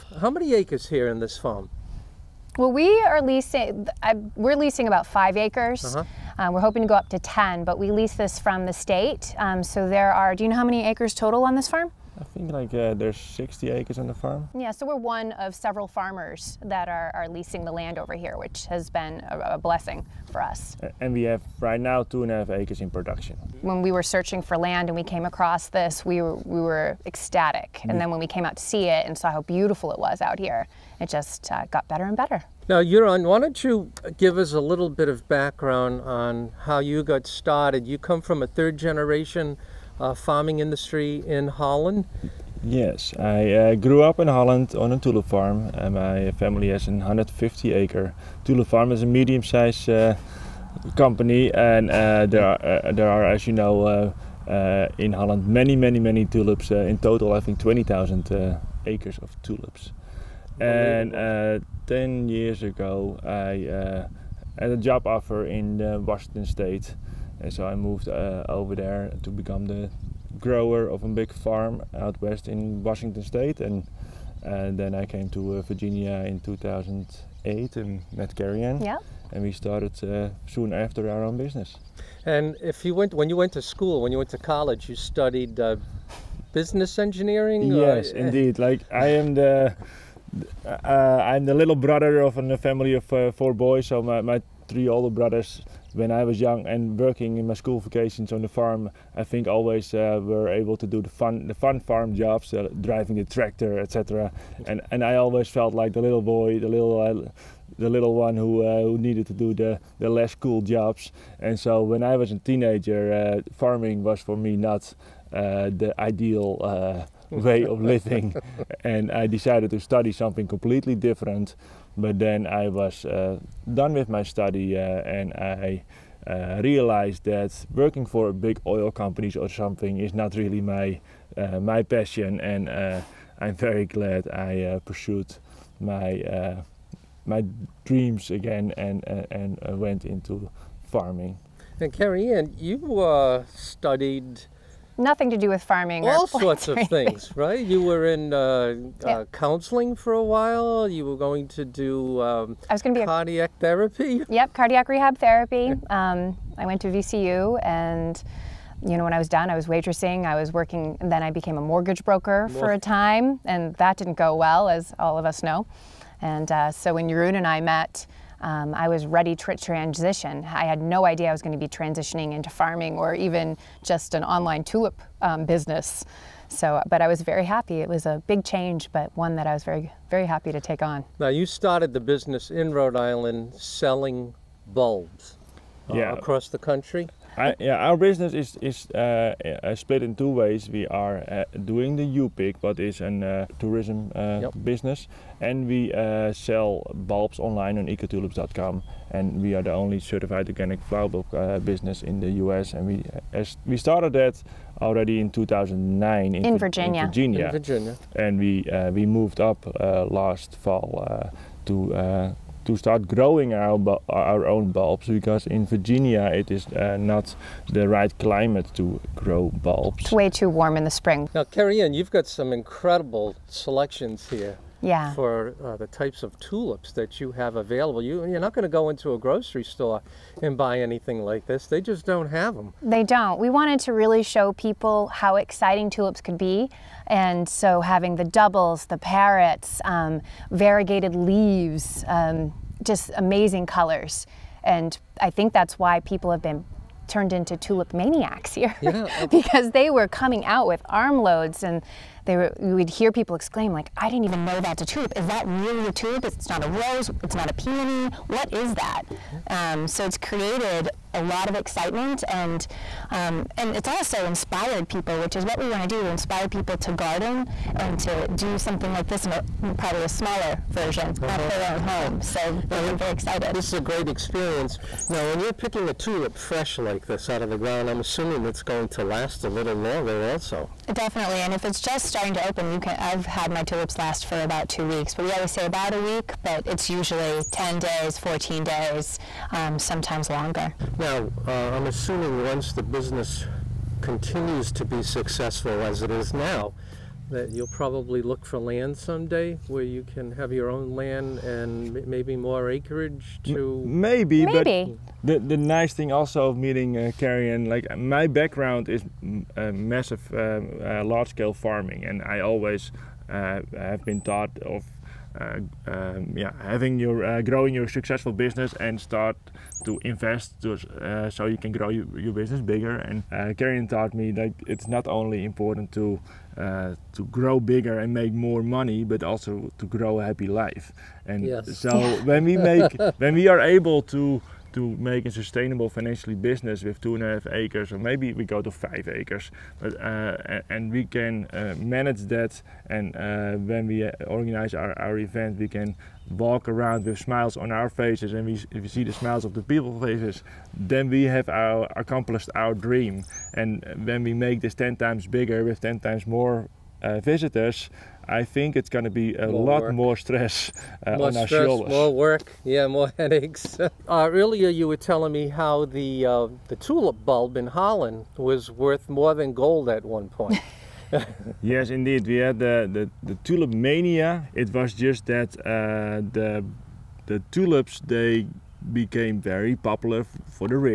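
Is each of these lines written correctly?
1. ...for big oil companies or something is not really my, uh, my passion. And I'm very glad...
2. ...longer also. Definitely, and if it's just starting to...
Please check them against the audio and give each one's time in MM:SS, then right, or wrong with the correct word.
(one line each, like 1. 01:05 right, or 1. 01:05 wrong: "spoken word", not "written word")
1. 02:08 right
2. 04:39 right.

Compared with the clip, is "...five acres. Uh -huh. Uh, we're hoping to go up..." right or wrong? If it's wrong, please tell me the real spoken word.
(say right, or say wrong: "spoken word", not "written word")
right.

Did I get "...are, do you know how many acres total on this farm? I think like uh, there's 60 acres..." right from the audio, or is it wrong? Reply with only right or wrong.
right.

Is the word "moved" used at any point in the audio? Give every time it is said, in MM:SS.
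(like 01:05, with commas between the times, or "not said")
01:07, 03:29.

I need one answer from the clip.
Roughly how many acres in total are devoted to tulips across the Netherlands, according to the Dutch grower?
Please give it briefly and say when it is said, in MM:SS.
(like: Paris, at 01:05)
20,000 acres, at 00:57.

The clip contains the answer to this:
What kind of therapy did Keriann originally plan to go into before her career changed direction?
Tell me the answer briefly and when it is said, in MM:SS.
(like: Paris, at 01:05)
Cardiac rehab therapy, at 02:34.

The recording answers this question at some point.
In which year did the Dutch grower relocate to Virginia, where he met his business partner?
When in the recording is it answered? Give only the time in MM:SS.
01:16.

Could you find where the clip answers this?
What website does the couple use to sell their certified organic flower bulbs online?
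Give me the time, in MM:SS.
03:17.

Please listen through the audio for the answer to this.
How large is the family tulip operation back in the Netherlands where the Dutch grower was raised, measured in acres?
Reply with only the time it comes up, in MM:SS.
00:46.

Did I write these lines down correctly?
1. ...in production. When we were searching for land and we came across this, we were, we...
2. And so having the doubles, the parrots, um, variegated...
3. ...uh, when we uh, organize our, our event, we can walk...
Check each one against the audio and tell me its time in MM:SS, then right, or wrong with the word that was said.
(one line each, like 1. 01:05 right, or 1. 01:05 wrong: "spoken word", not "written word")
1. 00:22 right
2. 03:57 right
3. 05:43 right.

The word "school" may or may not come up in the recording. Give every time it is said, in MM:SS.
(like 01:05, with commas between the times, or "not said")
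01:23, 01:37.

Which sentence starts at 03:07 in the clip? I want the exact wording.
I, yeah, our business is is uh, uh, split in two ways.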